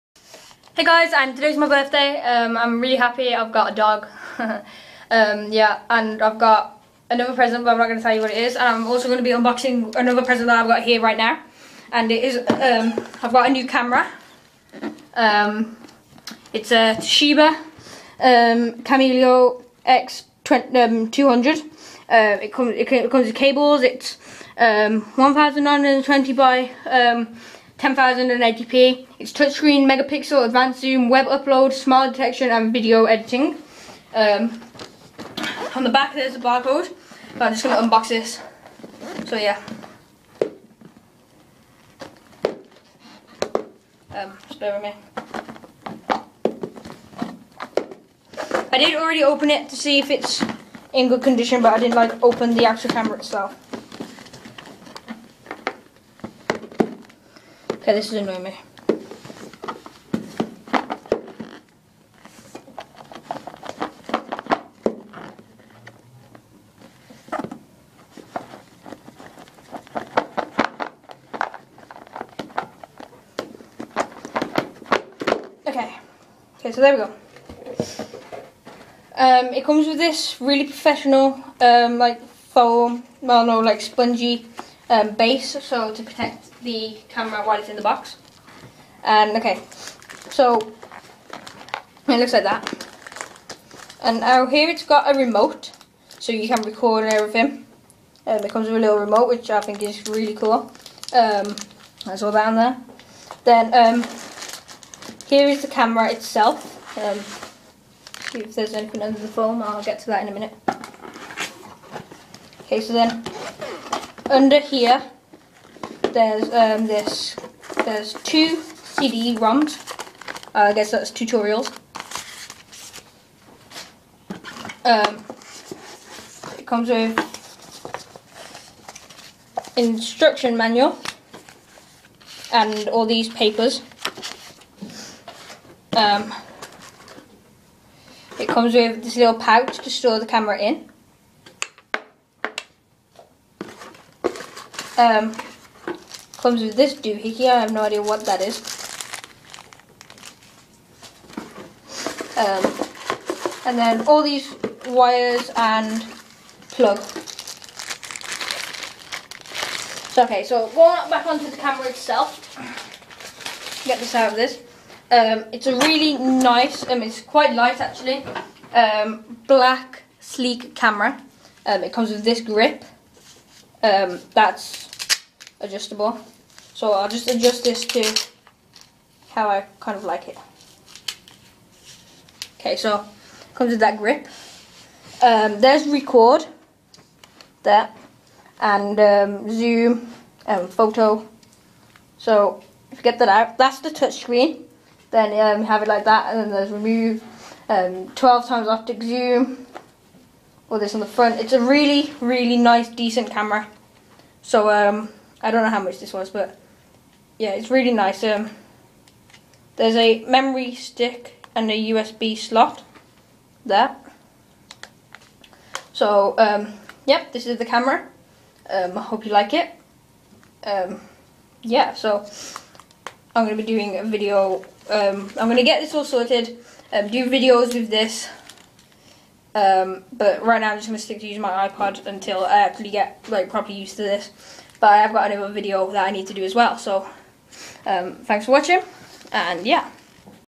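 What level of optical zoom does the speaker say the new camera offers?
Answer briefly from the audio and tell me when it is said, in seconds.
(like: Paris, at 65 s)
12 times, at 198 s.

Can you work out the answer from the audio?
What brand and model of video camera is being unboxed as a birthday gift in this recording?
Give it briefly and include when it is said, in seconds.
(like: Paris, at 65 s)
Toshiba Camileo X200, at 16 s.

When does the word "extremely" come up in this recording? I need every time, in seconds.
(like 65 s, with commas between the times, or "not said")
not said.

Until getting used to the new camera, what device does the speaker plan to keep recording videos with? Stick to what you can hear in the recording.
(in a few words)
iPod.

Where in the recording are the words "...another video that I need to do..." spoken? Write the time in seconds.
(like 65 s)
235 s.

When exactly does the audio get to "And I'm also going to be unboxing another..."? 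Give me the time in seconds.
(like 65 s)
8 s.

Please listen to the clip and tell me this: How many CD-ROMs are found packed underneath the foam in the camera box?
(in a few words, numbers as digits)
2.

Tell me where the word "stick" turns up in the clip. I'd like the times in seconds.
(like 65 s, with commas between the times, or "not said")
210 s, 231 s.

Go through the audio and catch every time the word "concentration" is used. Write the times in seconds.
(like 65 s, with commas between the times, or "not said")
not said.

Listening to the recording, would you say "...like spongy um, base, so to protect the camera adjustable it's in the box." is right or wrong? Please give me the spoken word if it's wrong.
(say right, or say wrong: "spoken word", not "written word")
wrong: "while", not "adjustable".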